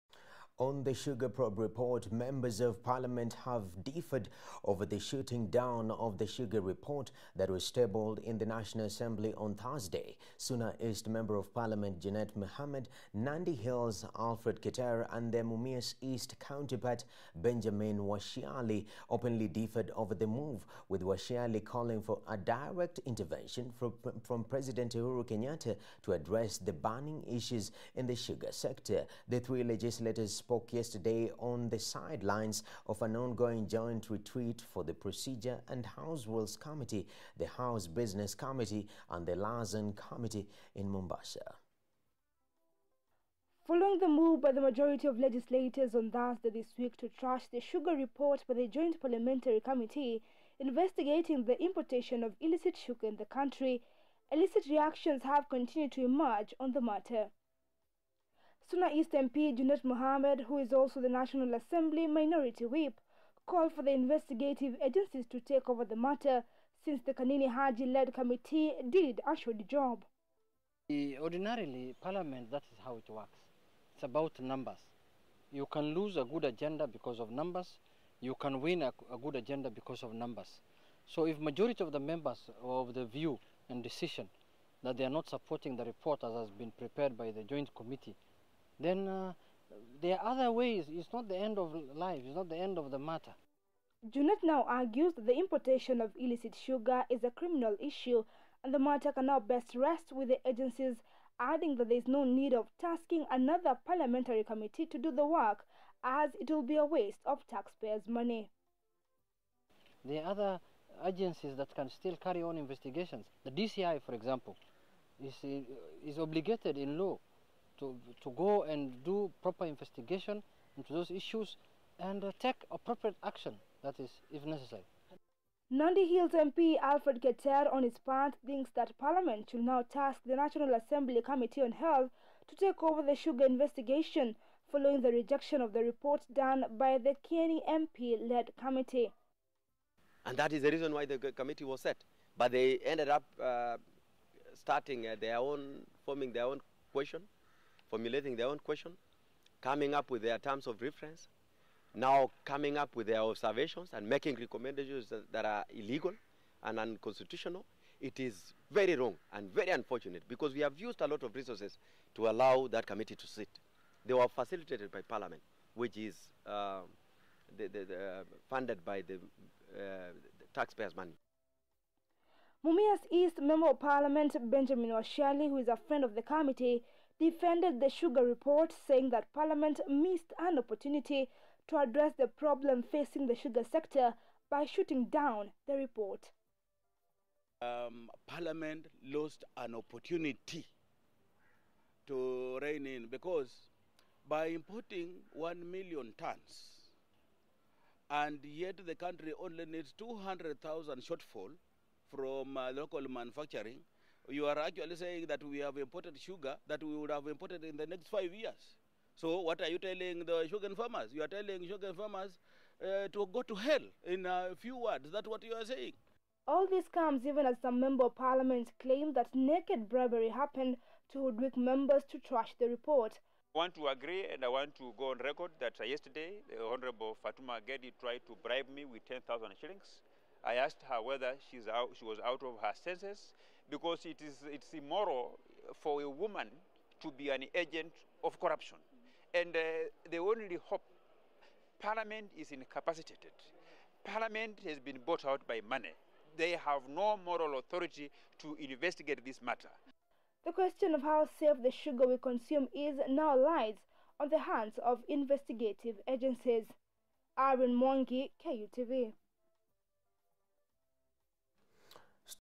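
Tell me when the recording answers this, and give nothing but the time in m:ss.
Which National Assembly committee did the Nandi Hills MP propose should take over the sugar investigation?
2:11.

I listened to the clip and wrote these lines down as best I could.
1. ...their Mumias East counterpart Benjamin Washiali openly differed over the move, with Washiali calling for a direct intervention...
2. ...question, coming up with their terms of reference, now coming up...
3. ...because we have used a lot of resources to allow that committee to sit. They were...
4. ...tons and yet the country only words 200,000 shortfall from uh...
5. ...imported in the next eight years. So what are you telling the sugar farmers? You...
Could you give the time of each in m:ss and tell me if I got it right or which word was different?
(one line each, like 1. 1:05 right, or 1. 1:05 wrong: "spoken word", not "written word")
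1. 0:15 right
2. 2:28 right
3. 2:40 right
4. 3:16 wrong: "needs", not "words"
5. 3:27 wrong: "five", not "eight".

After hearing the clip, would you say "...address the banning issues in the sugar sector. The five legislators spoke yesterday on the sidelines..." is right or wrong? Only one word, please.
wrong.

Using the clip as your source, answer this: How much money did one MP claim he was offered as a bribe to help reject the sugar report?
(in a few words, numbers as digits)
10,000 shillings.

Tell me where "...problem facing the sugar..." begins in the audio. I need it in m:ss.
3:02.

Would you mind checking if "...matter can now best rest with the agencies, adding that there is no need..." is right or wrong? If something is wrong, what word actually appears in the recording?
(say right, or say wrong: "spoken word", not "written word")
right.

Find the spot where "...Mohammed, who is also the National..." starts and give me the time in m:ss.
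0:59.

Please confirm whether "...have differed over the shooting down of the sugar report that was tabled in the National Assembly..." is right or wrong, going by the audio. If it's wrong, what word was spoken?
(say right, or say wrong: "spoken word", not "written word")
right.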